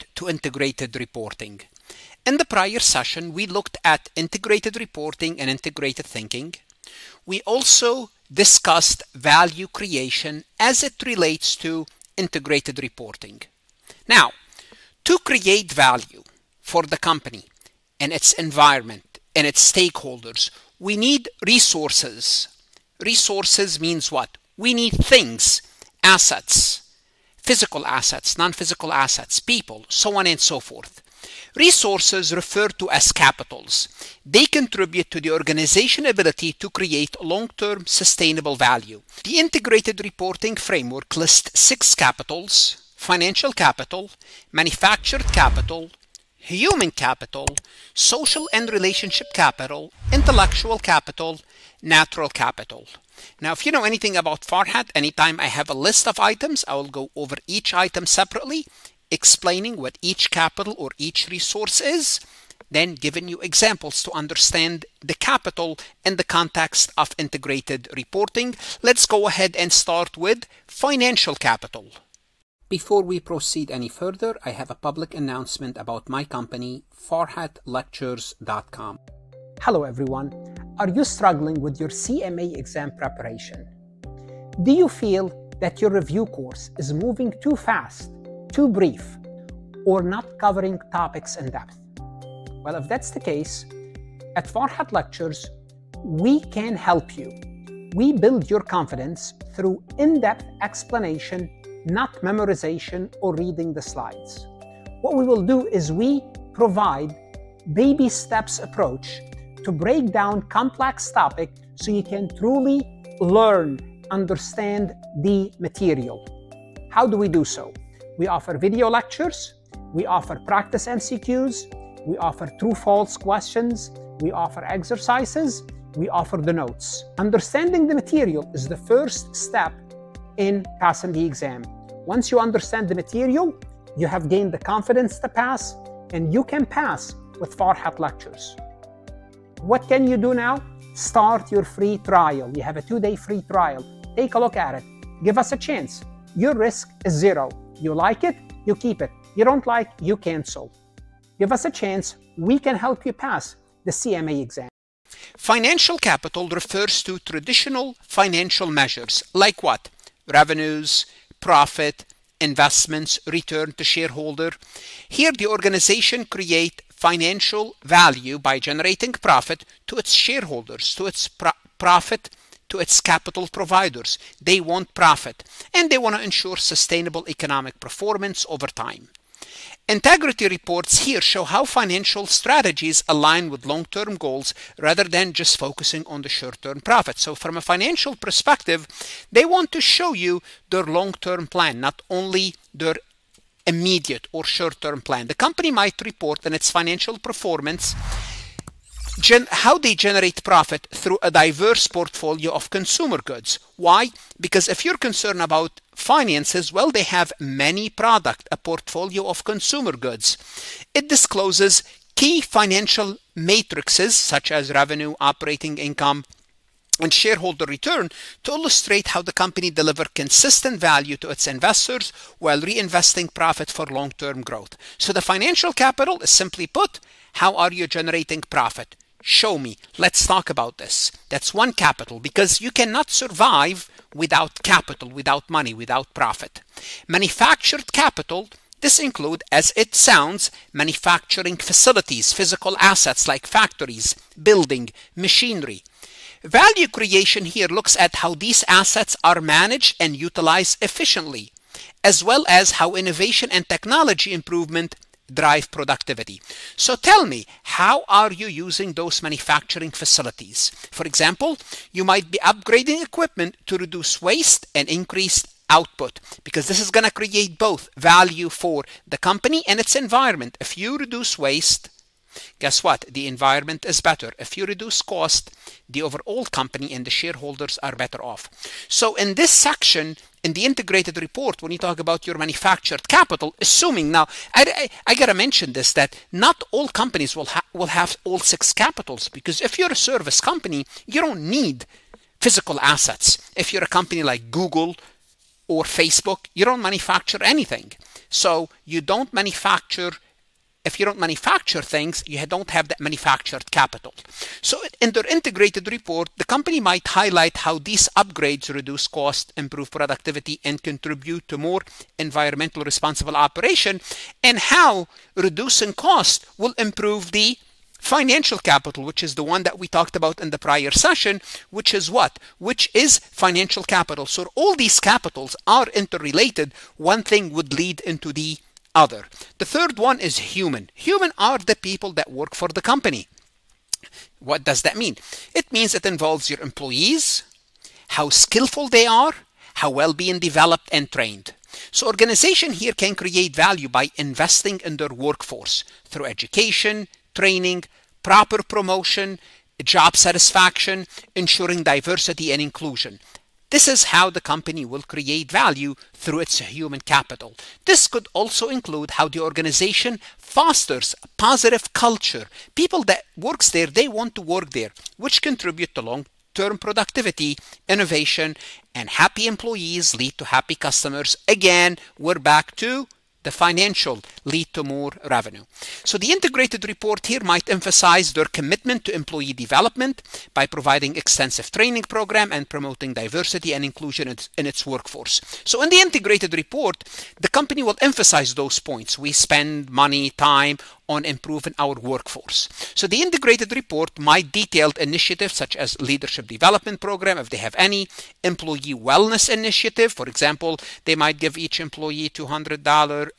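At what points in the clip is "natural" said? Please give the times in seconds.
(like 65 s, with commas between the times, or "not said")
51 s.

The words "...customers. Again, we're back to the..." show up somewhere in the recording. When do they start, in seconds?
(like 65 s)
370 s.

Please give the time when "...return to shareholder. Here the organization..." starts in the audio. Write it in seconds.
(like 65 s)
163 s.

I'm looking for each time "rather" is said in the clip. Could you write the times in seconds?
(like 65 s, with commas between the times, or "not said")
184 s.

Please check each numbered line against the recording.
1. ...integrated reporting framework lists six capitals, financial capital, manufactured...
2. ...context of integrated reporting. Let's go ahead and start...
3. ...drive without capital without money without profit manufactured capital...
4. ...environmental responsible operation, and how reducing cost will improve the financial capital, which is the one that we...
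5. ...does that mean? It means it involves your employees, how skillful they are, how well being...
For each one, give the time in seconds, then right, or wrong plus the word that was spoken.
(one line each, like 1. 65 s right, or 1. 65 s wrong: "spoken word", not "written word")
1. 39 s right
2. 66 s right
3. 233 s wrong: "survive", not "drive"
4. 312 s right
5. 334 s right.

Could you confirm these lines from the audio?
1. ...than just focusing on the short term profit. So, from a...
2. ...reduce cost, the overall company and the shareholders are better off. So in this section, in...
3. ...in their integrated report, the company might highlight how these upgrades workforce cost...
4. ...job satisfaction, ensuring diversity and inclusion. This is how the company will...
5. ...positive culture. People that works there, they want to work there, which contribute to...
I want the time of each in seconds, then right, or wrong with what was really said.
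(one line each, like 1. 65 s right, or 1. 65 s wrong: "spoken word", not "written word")
1. 185 s right
2. 274 s right
3. 304 s wrong: "reduce", not "workforce"
4. 349 s right
5. 361 s right.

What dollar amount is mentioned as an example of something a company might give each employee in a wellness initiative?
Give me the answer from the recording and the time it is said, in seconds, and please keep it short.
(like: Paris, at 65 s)
$200, at 402 s.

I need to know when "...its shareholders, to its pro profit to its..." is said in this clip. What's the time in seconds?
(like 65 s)
169 s.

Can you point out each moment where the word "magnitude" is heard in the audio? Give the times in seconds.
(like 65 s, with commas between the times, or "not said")
not said.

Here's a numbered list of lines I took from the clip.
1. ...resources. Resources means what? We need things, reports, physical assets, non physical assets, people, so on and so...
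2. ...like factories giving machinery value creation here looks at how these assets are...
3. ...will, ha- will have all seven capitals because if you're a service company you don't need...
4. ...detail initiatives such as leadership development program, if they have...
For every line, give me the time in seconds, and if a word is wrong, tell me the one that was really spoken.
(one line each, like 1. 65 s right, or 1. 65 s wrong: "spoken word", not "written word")
1. 21 s wrong: "assets", not "reports"
2. 243 s wrong: "building", not "giving"
3. 287 s wrong: "six", not "seven"
4. 394 s right.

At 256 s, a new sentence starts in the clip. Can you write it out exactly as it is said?
So tell me, how are you using those manufacturing facilities?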